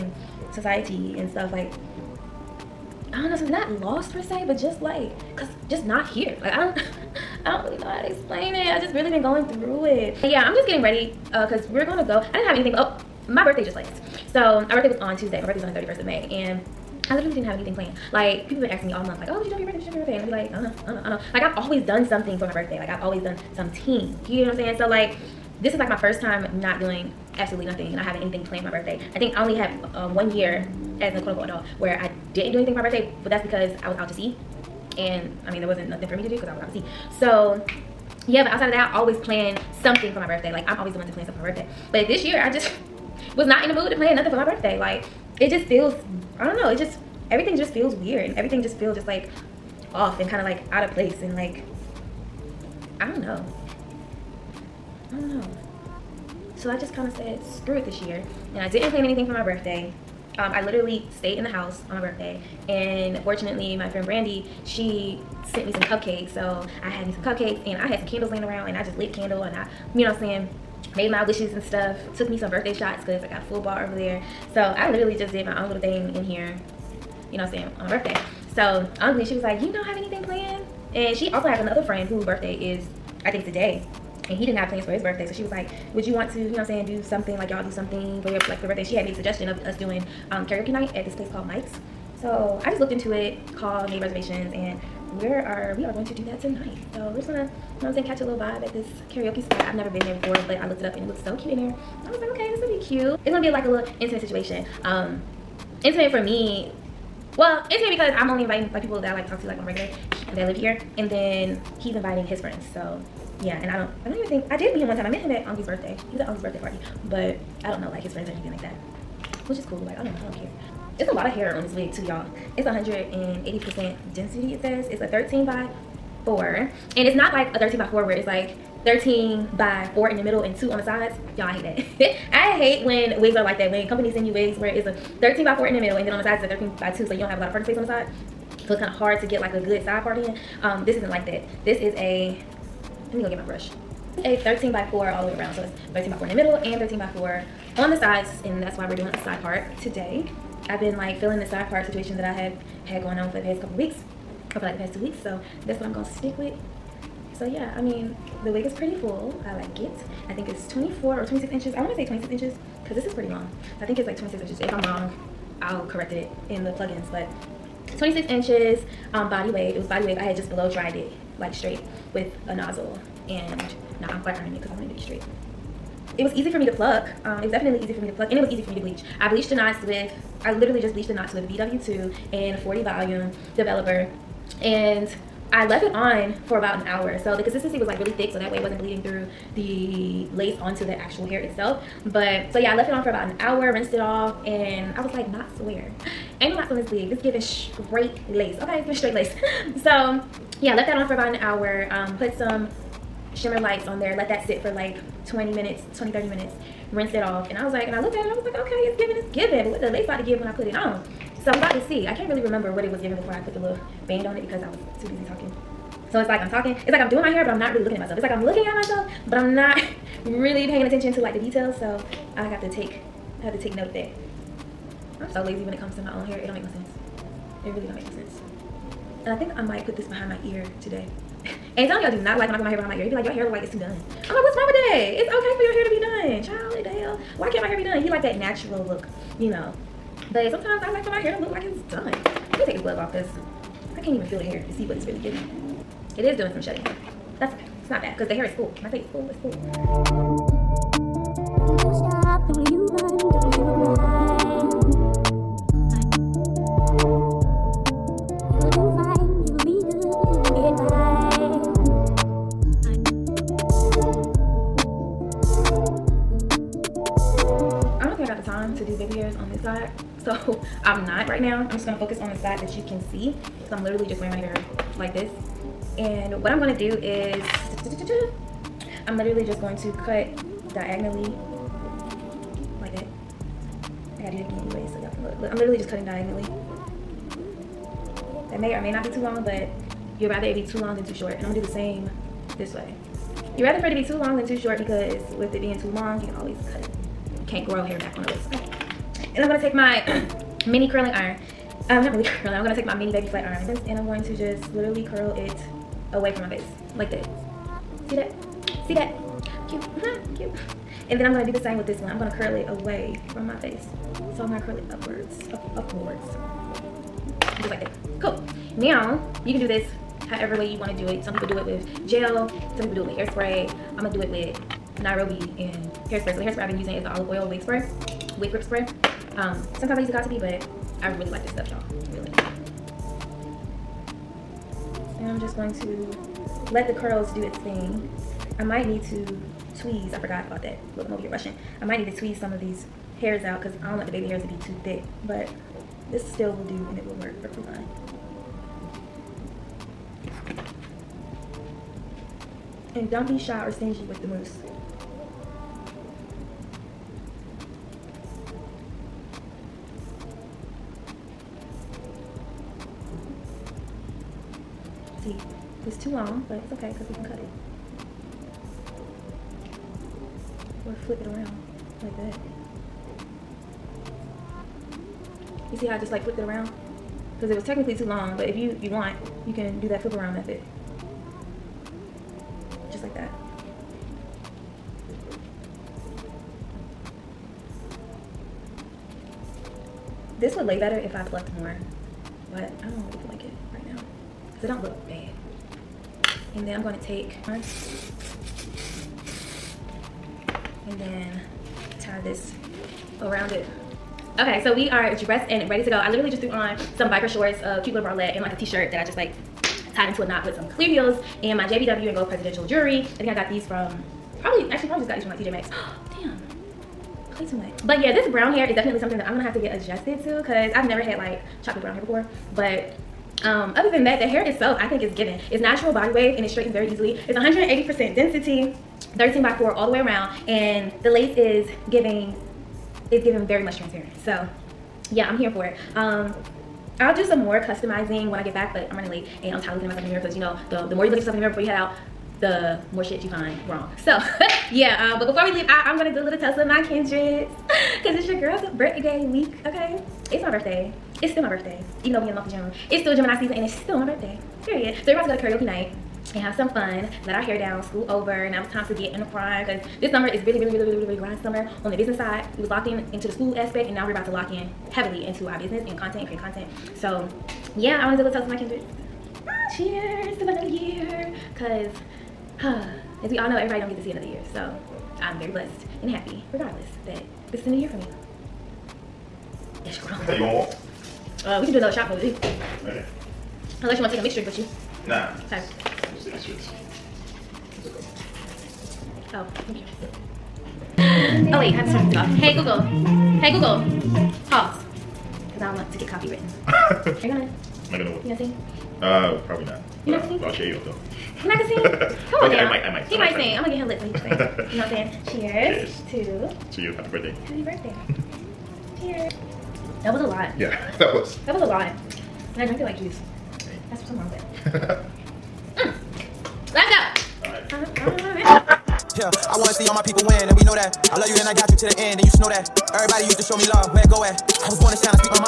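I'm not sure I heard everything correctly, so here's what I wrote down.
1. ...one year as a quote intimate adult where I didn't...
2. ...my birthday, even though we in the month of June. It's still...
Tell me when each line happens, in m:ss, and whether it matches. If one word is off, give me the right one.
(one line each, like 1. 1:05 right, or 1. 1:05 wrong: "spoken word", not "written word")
1. 0:30 wrong: "unquote", not "intimate"
2. 7:31 right.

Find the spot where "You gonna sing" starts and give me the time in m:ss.
8:18.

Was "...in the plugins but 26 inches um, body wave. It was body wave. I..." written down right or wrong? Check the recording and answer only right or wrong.
right.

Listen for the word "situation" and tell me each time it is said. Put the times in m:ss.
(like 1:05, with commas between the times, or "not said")
1:44, 2:31.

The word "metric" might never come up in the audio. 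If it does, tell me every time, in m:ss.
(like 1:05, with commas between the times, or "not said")
not said.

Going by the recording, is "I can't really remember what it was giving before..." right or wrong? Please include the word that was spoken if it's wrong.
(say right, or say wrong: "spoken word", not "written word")
right.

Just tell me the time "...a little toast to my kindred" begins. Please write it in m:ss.
7:48.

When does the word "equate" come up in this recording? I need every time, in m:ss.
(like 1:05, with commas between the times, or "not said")
not said.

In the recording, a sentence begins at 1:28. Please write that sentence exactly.
She had made a suggestion of us doing um, karaoke night at this place called Mike's.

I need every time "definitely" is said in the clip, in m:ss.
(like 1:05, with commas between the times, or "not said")
2:57, 6:58.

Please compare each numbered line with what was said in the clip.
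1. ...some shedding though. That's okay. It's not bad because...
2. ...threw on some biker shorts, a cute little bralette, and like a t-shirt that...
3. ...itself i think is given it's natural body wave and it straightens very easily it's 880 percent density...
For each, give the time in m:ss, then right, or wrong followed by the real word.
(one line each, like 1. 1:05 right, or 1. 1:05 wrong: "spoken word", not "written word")
1. 4:06 right
2. 6:46 right
3. 7:04 wrong: "180", not "880".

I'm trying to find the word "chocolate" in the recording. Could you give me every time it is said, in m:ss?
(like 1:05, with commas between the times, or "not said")
7:01.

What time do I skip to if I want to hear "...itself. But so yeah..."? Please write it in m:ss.
3:11.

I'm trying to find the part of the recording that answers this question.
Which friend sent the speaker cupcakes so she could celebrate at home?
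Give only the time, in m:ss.
1:04.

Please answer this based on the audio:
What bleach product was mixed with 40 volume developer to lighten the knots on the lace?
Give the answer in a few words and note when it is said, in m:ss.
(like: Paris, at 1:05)
BW2, at 3:01.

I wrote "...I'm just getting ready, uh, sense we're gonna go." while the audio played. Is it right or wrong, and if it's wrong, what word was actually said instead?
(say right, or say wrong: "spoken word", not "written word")
wrong: "cause", not "sense".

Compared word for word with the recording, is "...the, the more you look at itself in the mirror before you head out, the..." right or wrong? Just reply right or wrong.
wrong.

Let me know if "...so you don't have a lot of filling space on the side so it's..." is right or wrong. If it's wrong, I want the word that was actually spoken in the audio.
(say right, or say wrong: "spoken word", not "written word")
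wrong: "parting", not "filling".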